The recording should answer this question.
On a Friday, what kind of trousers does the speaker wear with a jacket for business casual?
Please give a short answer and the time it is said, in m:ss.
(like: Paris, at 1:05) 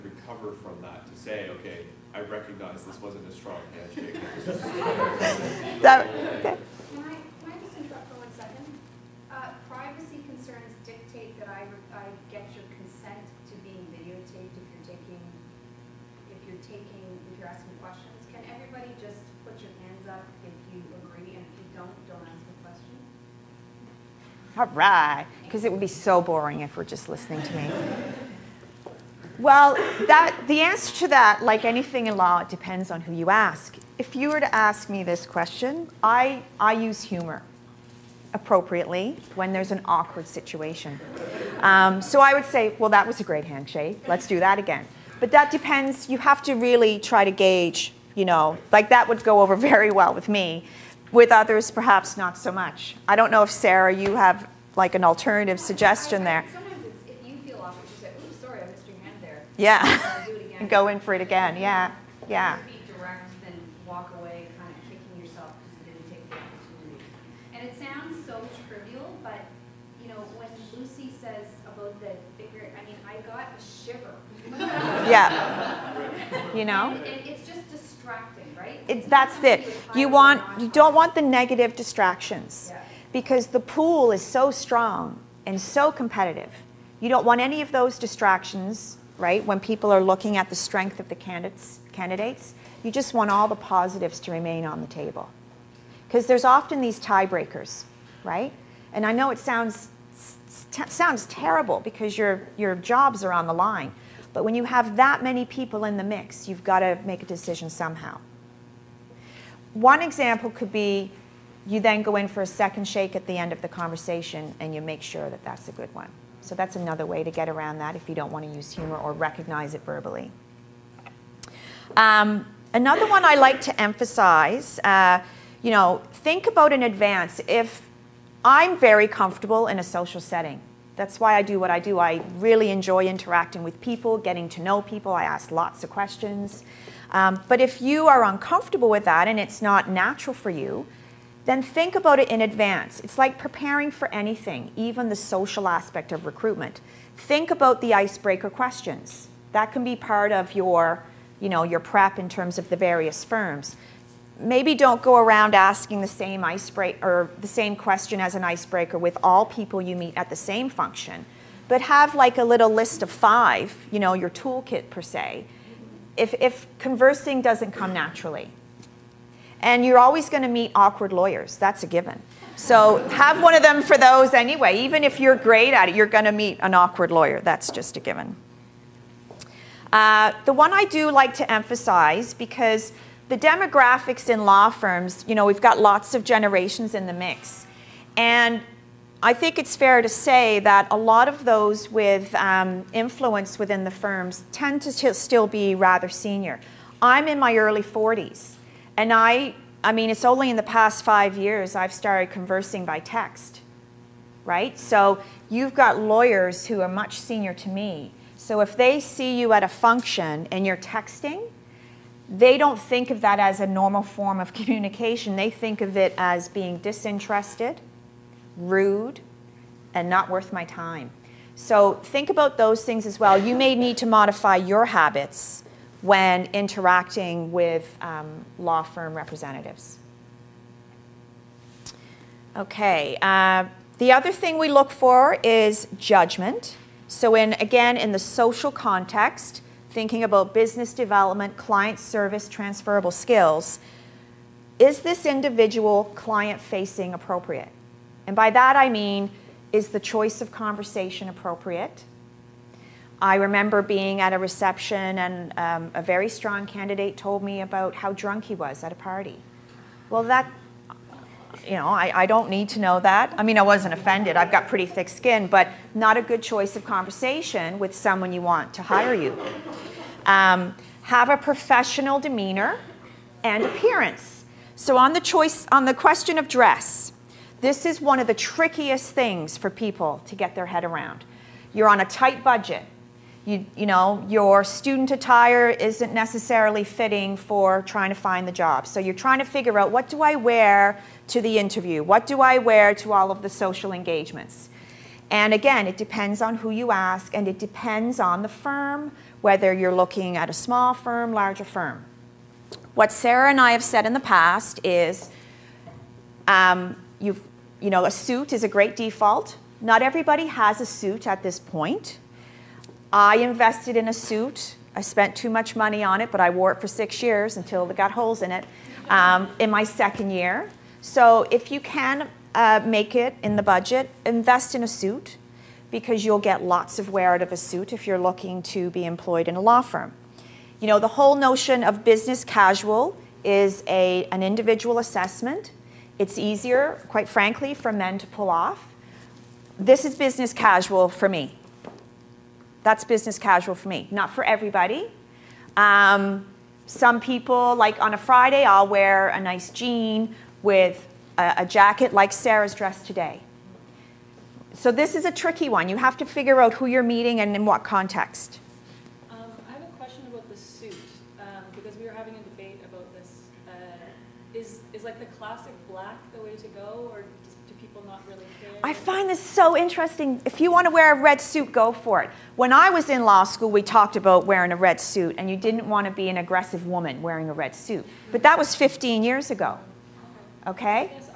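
nice jean, at 5:49.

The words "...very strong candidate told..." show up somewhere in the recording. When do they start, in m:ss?
4:16.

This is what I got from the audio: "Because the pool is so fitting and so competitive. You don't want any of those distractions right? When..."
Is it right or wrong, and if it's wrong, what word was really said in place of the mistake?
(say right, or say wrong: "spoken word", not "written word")
wrong: "strong", not "fitting".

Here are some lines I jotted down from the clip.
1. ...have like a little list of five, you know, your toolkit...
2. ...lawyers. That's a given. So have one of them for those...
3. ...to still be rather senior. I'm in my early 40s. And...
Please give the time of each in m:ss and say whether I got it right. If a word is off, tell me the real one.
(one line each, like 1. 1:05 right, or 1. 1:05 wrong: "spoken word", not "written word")
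1. 2:41 right
2. 2:51 right
3. 3:14 right.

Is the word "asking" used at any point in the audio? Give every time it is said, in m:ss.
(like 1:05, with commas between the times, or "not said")
0:17, 2:35.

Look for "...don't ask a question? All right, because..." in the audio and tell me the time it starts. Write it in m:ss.
0:22.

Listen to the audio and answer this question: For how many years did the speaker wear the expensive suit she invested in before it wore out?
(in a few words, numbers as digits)
6.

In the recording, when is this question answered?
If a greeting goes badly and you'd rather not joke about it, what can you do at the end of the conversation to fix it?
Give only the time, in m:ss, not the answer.
1:52.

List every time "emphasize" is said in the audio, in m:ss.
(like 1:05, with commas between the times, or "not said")
2:03, 3:01.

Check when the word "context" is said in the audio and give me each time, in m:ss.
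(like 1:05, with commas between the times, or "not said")
3:58, 5:57.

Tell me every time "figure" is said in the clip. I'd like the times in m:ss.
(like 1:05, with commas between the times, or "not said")
4:49, 5:56.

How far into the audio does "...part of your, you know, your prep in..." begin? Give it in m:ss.
2:29.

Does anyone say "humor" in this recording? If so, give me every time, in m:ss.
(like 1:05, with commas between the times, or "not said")
0:37, 1:58.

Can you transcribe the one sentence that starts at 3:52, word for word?
Okay, uh, the other thing we look for is judgment.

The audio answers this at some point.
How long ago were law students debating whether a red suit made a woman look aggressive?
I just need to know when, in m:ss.
6:18.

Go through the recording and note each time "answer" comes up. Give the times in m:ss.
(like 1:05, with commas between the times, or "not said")
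0:30.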